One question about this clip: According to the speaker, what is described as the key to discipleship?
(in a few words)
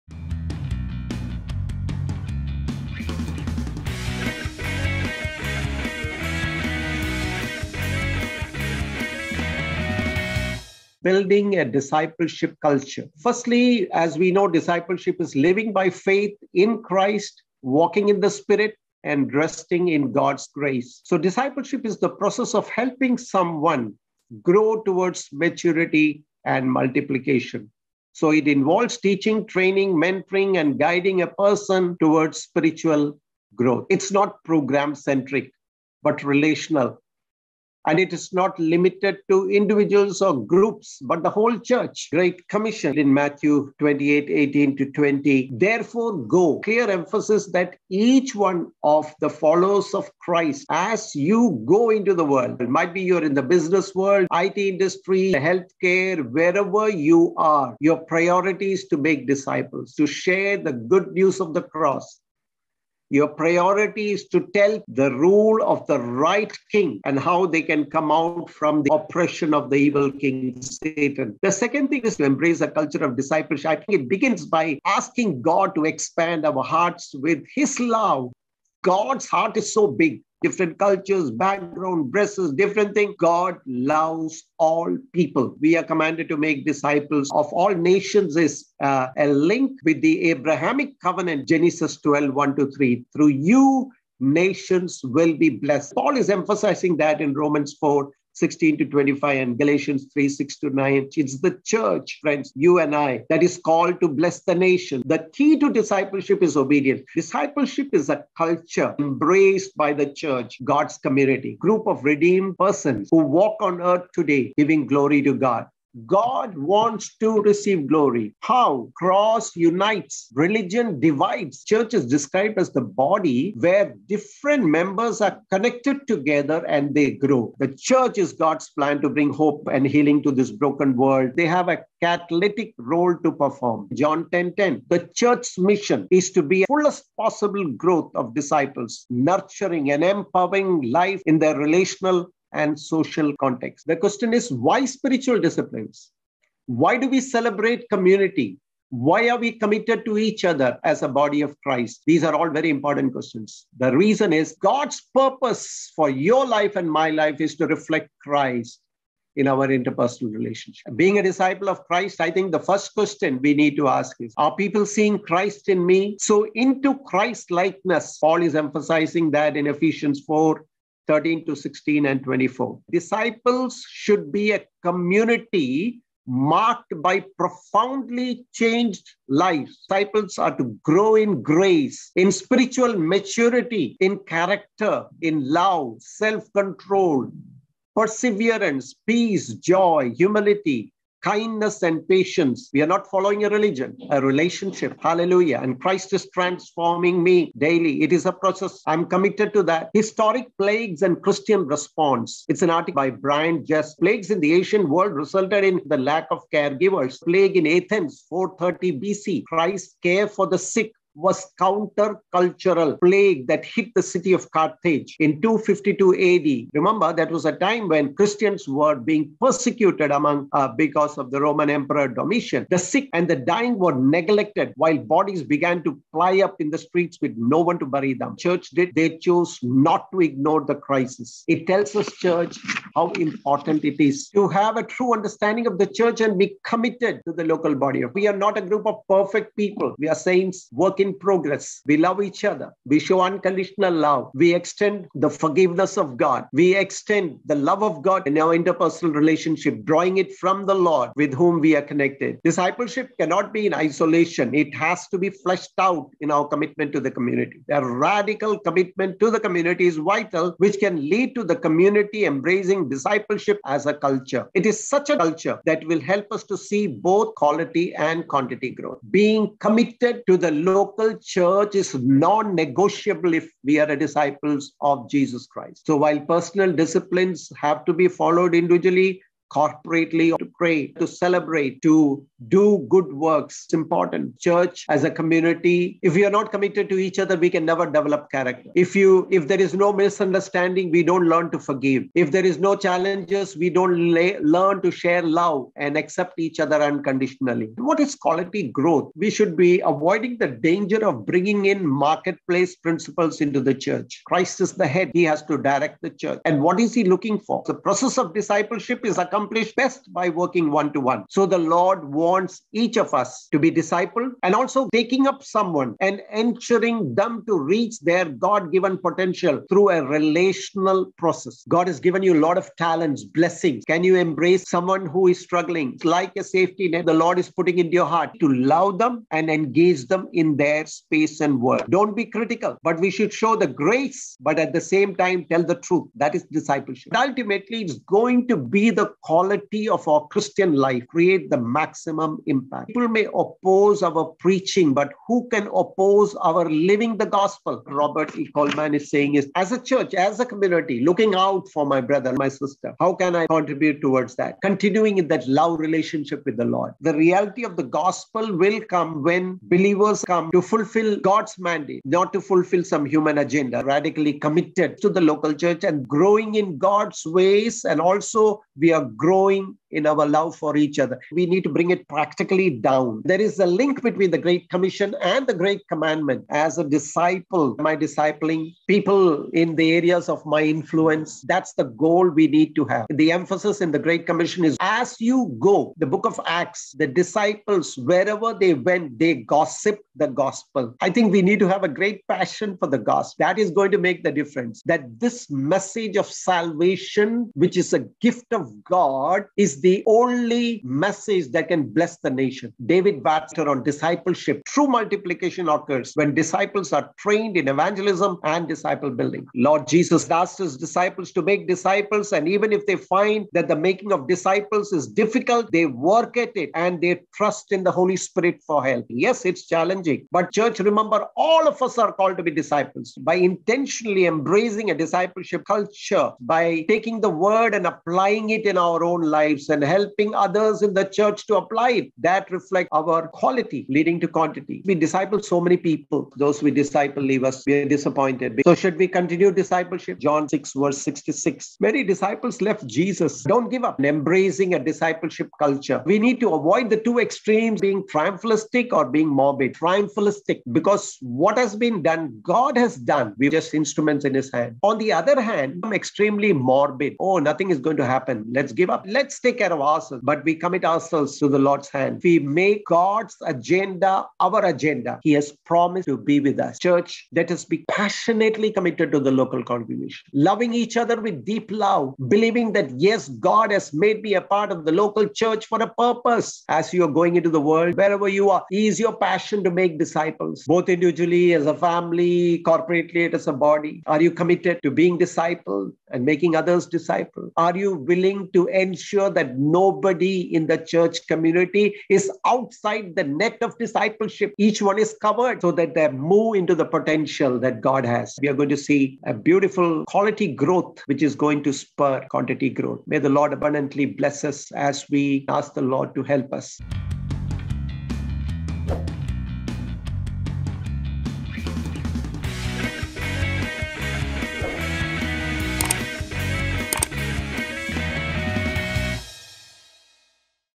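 Obedience.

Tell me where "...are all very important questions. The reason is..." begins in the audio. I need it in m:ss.
2:32.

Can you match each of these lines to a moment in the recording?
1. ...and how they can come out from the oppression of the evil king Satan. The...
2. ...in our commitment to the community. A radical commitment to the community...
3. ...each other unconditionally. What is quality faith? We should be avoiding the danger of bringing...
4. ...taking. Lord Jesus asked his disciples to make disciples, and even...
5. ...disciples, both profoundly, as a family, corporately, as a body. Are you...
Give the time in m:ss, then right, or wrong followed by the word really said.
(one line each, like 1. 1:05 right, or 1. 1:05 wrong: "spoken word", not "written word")
1. 1:07 right
2. 4:16 right
3. 4:56 wrong: "growth", not "faith"
4. 6:49 wrong: "building", not "taking"
5. 7:59 wrong: "individually", not "profoundly".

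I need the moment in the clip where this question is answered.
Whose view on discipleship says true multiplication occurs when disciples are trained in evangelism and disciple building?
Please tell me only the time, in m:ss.
6:42.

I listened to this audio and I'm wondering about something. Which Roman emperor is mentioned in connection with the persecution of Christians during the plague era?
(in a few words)
Domitian.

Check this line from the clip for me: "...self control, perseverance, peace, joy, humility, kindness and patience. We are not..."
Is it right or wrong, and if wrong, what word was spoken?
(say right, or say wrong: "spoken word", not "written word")
right.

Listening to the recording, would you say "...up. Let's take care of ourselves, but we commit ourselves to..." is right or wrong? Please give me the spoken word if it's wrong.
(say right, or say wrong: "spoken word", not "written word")
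right.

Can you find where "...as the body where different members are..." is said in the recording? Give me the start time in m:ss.
2:02.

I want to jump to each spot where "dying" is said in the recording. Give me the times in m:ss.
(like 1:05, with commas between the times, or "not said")
3:43.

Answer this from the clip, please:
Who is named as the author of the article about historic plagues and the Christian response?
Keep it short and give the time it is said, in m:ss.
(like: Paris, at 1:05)
Brian Jess, at 3:23.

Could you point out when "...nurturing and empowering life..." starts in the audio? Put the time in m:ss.
2:19.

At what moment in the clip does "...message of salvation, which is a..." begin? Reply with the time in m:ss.
6:35.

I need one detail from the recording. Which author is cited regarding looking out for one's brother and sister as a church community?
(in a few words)
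Robert E. Coleman.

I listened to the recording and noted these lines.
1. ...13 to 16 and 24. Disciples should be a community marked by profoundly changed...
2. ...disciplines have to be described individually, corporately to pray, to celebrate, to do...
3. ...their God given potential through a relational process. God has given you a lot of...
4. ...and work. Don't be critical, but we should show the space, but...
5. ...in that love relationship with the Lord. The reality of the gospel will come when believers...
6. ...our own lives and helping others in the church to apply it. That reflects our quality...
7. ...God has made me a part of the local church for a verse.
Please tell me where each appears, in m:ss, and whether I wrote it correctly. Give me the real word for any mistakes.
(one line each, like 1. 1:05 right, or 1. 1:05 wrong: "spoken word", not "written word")
1. 2:51 right
2. 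4:36 wrong: "followed", not "described"
3. 5:18 right
4. 5:31 wrong: "grace", not "space"
5. 5:55 right
6. 7:08 right
7. 7:53 wrong: "purpose", not "verse".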